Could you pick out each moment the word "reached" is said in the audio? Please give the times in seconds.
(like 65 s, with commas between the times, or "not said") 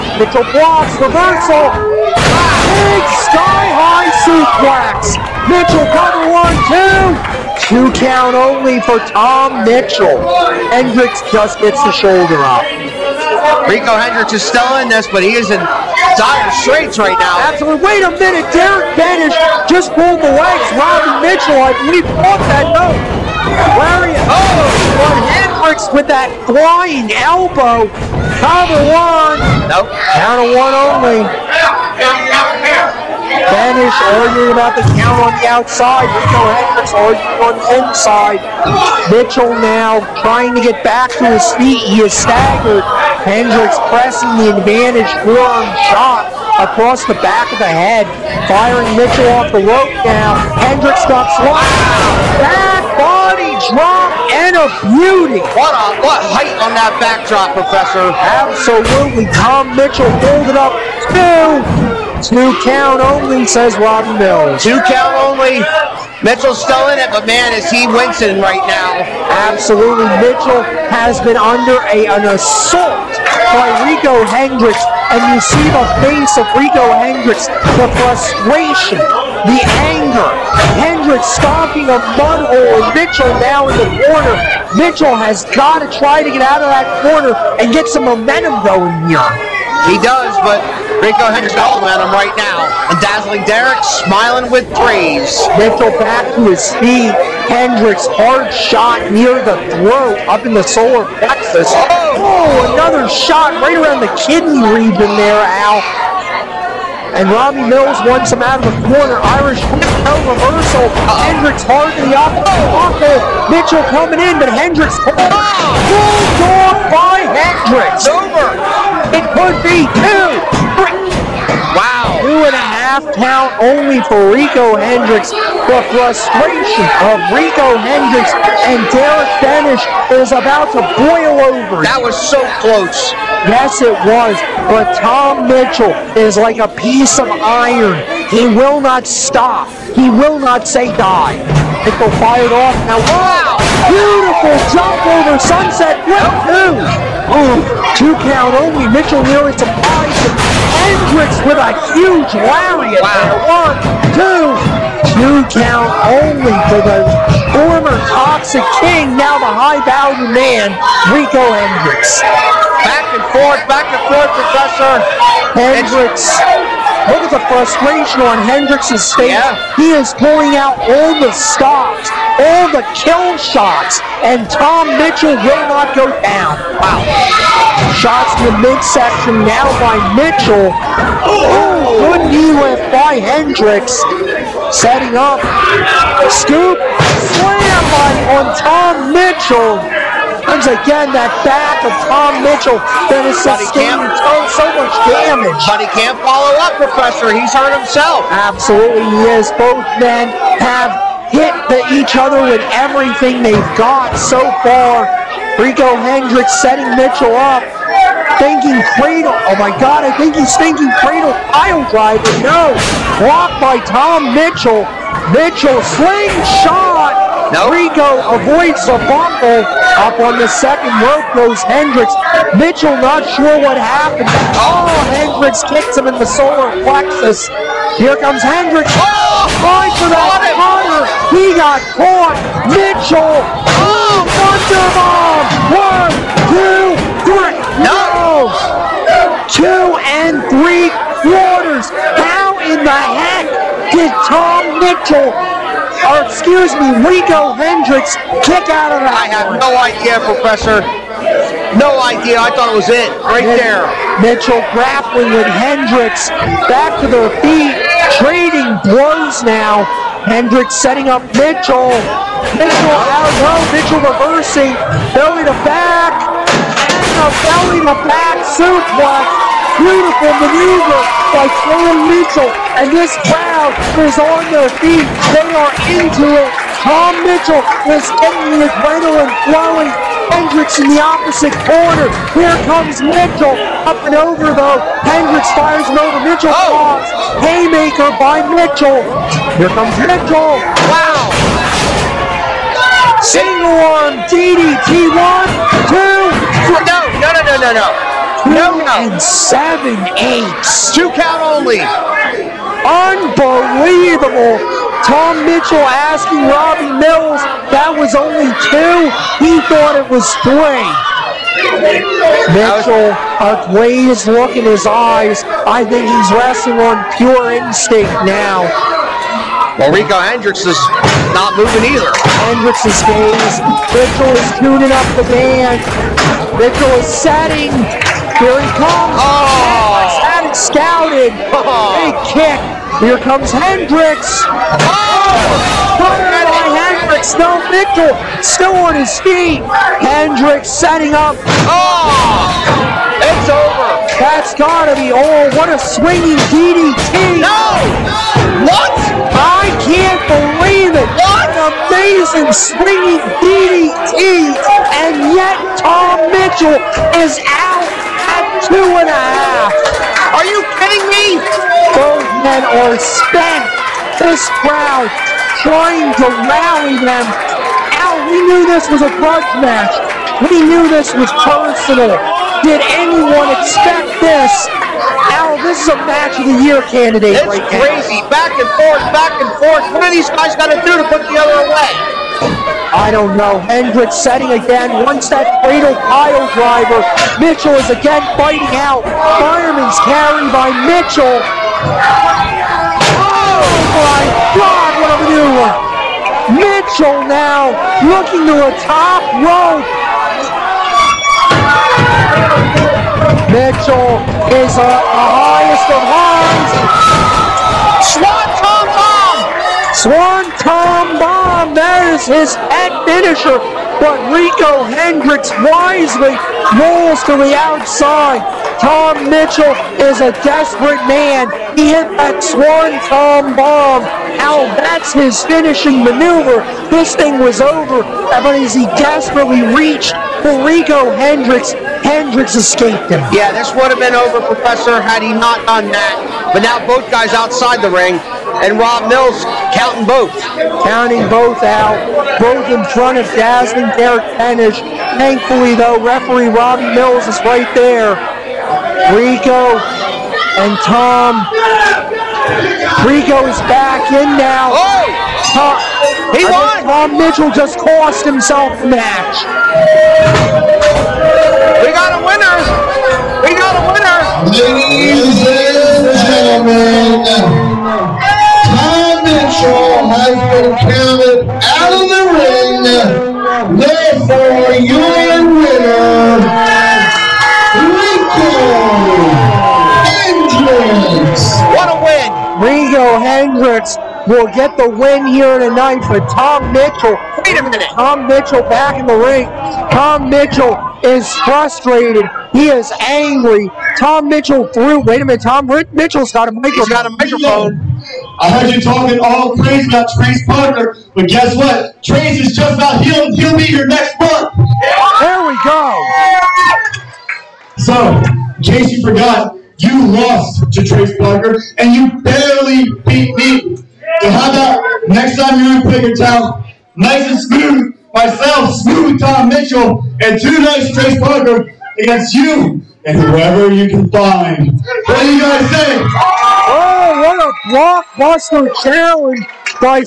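429 s.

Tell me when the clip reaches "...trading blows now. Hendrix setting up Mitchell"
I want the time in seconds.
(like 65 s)
258 s.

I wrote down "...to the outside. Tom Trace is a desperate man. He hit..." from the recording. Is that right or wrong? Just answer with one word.
wrong.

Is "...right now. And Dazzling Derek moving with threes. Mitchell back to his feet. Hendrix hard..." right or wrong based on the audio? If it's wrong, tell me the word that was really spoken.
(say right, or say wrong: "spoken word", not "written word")
wrong: "smiling", not "moving".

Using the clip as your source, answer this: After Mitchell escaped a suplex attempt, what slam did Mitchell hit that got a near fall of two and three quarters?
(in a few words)
Thunderbomb.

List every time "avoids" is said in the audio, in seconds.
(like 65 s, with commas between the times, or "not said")
218 s.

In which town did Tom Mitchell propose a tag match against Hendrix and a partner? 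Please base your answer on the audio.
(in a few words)
Quakertown.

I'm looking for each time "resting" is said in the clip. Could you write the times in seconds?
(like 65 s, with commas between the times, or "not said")
316 s.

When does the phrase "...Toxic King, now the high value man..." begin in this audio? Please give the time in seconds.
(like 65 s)
158 s.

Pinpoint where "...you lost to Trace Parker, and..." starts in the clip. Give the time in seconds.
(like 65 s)
509 s.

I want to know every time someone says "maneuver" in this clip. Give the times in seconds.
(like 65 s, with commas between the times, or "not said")
270 s, 395 s, 426 s.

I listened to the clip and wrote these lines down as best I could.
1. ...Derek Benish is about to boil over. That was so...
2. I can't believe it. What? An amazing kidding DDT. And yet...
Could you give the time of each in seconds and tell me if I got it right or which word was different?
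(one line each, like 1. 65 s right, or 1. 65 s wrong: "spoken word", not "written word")
1. 128 s right
2. 349 s wrong: "swinging", not "kidding".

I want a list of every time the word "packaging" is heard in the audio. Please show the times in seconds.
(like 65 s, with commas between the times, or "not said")
not said.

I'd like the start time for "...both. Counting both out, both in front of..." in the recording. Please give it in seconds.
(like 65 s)
440 s.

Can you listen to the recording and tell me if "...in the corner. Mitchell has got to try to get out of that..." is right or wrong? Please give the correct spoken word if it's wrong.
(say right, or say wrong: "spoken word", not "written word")
right.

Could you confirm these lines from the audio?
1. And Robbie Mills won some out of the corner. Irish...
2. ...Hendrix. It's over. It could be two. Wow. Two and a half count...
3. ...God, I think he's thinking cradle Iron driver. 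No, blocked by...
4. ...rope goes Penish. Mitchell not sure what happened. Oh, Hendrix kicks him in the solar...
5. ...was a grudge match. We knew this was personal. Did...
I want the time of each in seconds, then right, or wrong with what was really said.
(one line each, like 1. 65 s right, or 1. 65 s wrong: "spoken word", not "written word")
1. 107 s right
2. 117 s right
3. 209 s right
4. 221 s wrong: "Hendrix", not "Penish"
5. 368 s right.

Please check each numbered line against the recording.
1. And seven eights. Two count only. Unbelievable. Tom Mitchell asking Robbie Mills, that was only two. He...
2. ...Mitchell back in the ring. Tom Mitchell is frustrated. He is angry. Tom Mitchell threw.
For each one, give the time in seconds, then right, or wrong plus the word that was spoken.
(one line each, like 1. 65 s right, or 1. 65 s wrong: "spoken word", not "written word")
1. 299 s right
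2. 488 s right.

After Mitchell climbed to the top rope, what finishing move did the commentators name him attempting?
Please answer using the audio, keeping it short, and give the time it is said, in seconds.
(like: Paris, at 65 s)
Swanton Bomb, at 408 s.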